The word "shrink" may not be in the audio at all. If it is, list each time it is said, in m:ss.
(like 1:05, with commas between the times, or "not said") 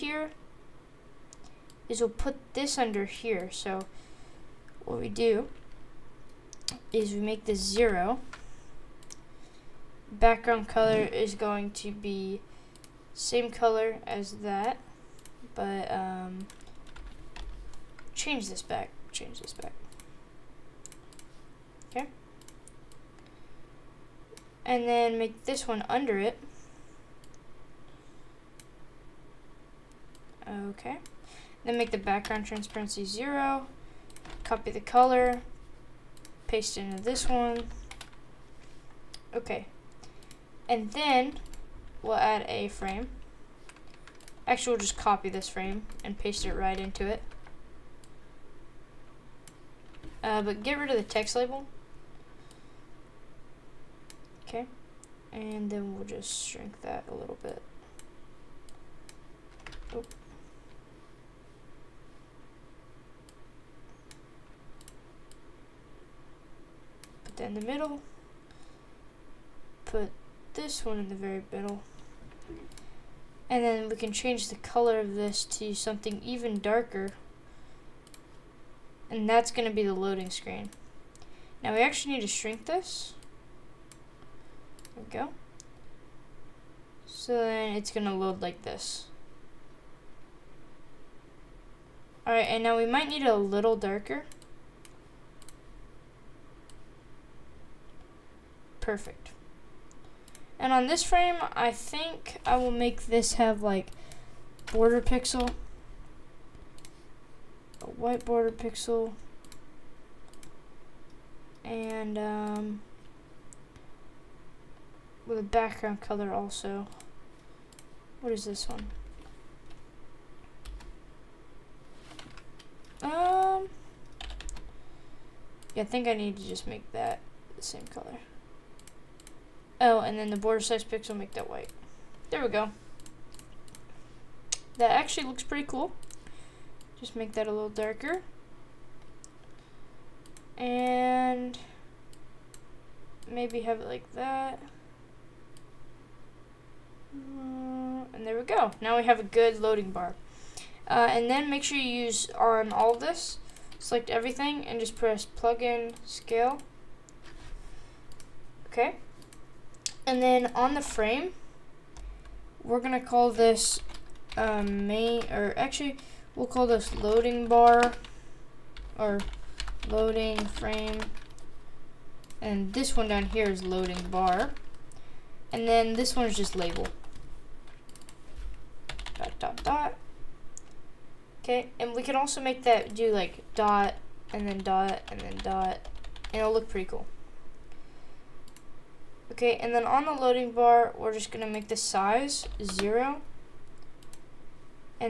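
0:56, 1:22.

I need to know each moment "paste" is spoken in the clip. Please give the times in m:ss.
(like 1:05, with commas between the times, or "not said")
0:36, 0:46.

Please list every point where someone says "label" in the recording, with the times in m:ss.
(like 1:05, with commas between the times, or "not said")
0:51, 2:56.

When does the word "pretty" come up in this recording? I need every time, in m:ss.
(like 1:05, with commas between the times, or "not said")
2:15, 3:06.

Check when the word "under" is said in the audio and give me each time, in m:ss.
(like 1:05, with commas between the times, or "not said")
0:02, 0:25.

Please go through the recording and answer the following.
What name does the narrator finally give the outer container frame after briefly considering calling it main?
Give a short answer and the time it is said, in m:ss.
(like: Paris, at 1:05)
loading frame, at 2:49.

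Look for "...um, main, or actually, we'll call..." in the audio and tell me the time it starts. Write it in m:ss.
2:44.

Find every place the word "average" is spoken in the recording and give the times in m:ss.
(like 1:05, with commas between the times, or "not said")
not said.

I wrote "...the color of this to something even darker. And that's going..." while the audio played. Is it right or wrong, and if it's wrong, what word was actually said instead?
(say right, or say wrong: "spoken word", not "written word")
right.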